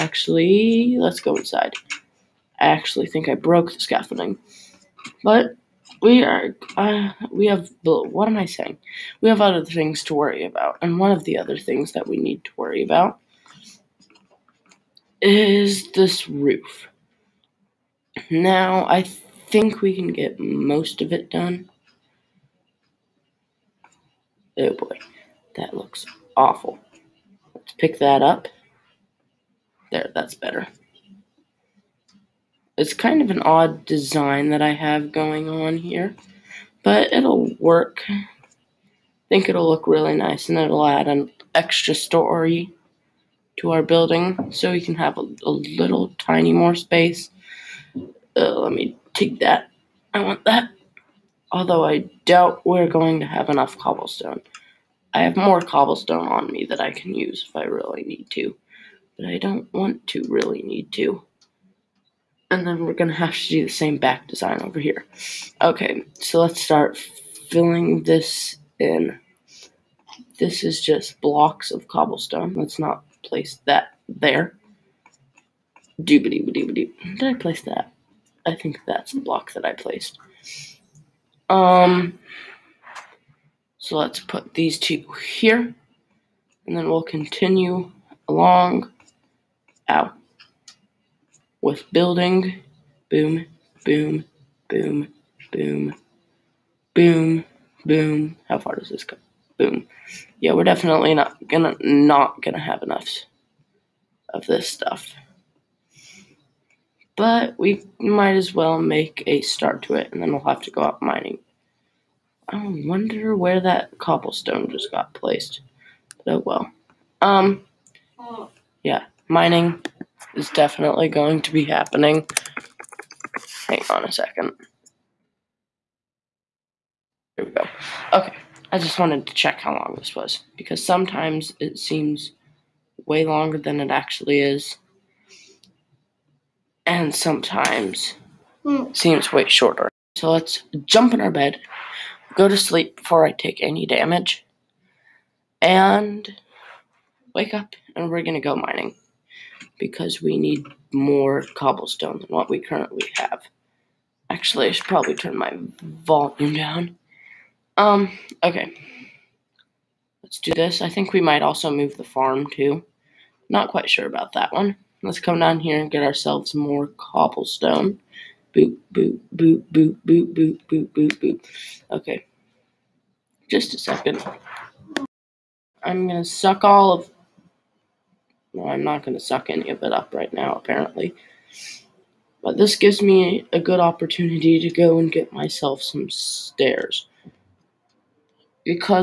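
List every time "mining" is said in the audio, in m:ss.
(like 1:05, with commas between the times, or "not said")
1:51, 1:59, 2:28.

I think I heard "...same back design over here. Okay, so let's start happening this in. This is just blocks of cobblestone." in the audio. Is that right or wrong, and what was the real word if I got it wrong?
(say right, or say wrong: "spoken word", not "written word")
wrong: "filling", not "happening".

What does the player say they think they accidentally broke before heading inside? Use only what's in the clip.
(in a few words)
The scaffolding.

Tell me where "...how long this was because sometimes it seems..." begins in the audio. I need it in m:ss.
2:09.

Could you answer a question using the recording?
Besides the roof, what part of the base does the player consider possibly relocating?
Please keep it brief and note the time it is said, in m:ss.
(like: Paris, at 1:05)
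The farm, at 2:41.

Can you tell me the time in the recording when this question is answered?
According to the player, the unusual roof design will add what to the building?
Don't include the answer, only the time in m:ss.
0:41.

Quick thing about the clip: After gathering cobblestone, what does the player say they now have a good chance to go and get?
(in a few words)
Stairs.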